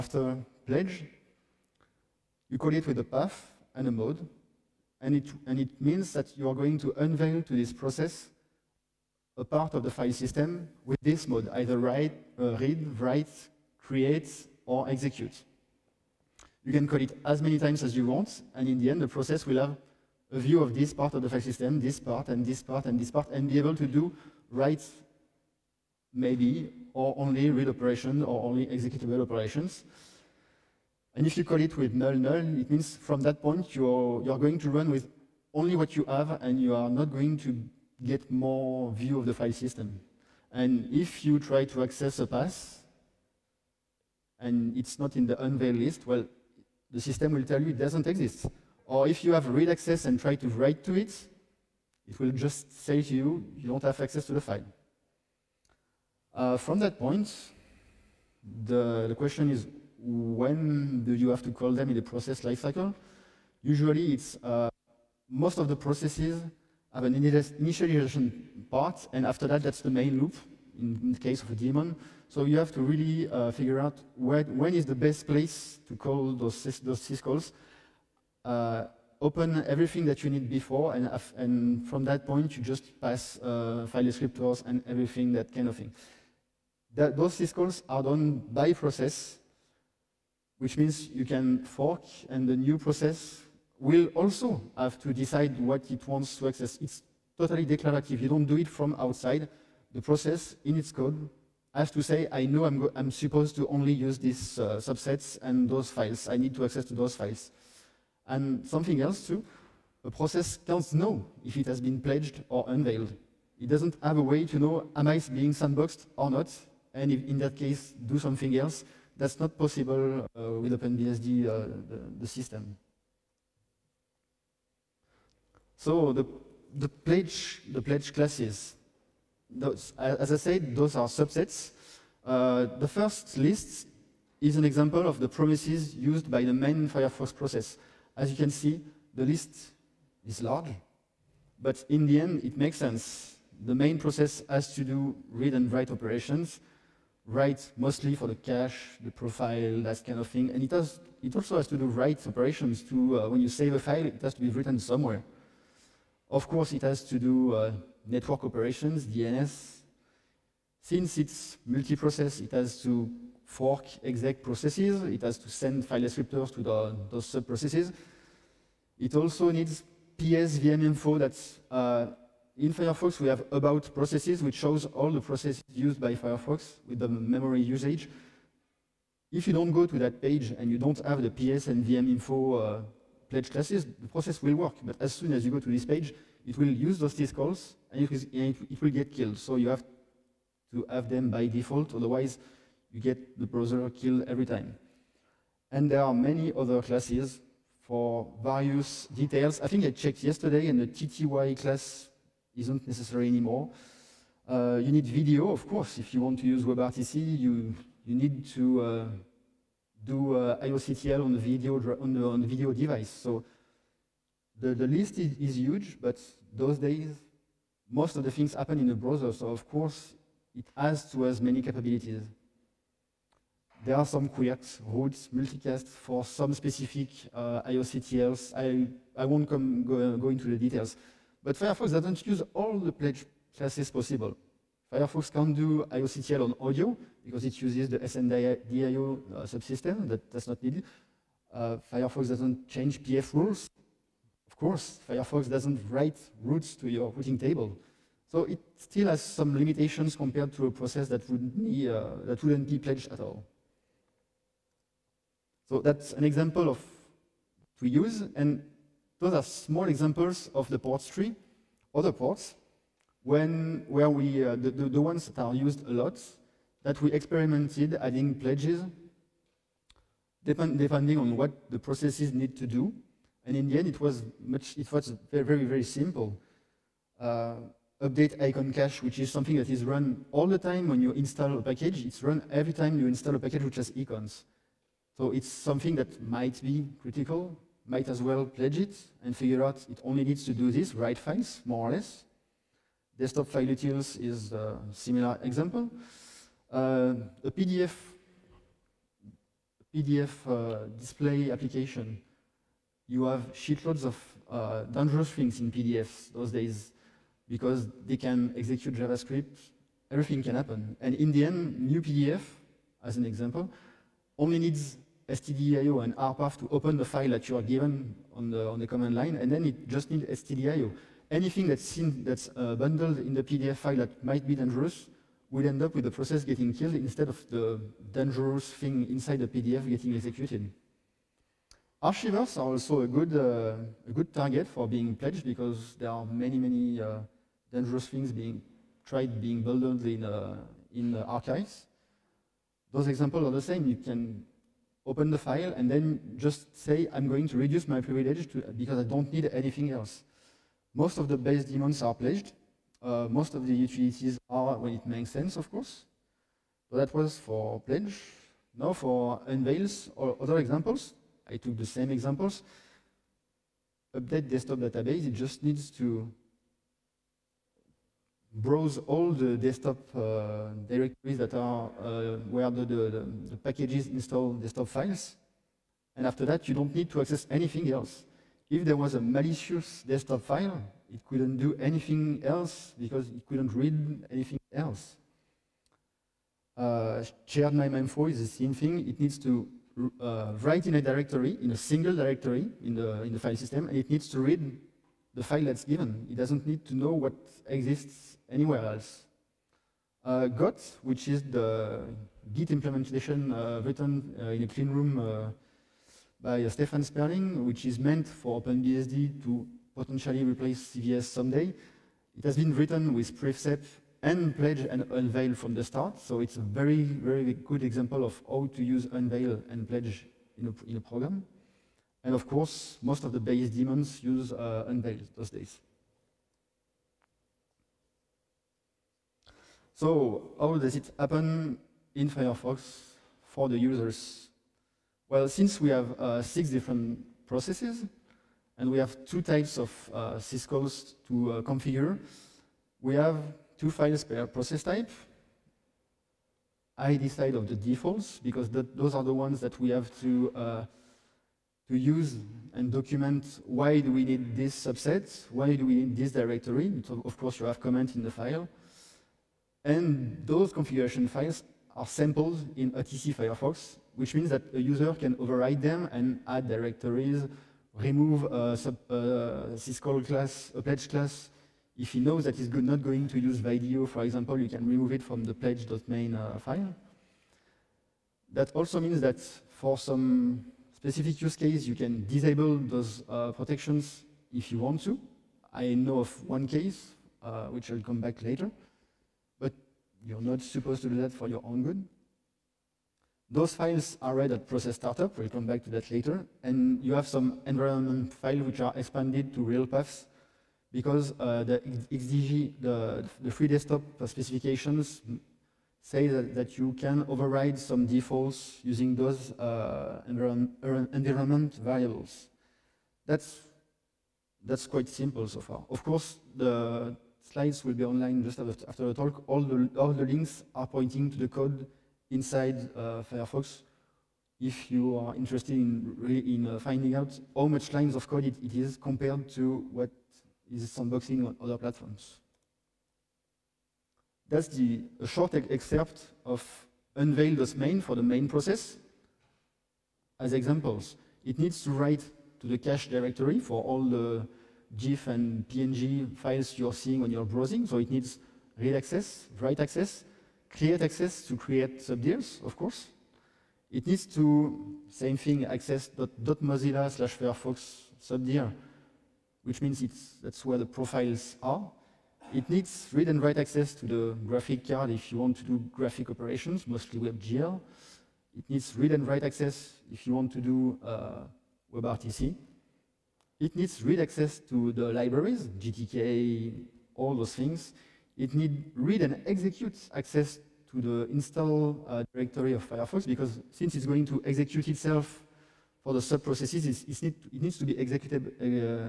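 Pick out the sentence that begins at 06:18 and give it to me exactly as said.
If there was a malicious desktop file, it couldn't do anything else because it couldn't read anything else.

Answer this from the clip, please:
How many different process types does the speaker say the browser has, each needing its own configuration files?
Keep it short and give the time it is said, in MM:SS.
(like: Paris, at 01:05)
six, at 07:16.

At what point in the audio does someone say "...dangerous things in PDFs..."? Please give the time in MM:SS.
05:04.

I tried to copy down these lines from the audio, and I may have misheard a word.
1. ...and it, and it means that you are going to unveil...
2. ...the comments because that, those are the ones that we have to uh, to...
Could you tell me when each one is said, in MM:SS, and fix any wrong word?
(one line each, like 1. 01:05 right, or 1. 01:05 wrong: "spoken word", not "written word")
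1. 00:05 right
2. 07:27 wrong: "defaults", not "comments".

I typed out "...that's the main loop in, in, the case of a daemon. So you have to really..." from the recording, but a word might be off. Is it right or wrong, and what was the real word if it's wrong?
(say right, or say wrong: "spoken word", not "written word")
right.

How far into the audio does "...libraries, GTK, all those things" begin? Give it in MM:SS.
09:35.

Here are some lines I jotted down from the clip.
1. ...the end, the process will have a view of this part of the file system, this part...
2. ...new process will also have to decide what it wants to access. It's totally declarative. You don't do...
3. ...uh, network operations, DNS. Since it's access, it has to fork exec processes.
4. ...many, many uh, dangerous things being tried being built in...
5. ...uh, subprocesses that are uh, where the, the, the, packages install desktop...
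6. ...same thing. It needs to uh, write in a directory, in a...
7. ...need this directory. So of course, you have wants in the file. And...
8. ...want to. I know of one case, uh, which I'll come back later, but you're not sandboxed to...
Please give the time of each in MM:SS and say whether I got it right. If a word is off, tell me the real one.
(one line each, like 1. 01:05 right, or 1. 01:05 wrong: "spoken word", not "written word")
1. 00:18 right
2. 01:32 right
3. 02:37 wrong: "multiprocess", not "access"
4. 05:36 right
5. 06:10 wrong: "directories", not "subprocesses"
6. 06:28 right
7. 07:36 wrong: "comments", not "wants"
8. 08:04 wrong: "supposed", not "sandboxed".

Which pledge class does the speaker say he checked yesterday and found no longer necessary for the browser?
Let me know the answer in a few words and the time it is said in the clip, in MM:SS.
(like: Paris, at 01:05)
TTY, at 03:20.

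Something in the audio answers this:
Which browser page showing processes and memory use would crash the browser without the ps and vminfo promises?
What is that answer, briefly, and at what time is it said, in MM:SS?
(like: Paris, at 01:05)
about processes, at 02:53.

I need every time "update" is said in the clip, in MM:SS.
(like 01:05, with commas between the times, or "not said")
04:38, 06:04.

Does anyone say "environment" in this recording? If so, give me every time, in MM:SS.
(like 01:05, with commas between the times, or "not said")
08:17, 08:30.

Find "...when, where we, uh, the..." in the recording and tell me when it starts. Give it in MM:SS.
04:23.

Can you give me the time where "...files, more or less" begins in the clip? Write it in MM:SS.
04:51.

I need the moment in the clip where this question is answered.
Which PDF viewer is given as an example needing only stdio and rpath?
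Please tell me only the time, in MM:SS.
05:11.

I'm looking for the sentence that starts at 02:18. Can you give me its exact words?
As you can see, the list is large, but in the end, it makes sense.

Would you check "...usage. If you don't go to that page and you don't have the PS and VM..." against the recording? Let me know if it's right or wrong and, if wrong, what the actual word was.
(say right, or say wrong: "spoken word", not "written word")
right.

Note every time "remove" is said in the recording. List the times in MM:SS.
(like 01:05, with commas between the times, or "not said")
07:47, 07:54.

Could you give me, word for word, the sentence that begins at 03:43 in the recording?
There are some quirks, routes, multicast for some specific uh, IOCTLs.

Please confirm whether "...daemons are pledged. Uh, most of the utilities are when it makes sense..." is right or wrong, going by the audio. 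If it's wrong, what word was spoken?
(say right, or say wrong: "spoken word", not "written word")
right.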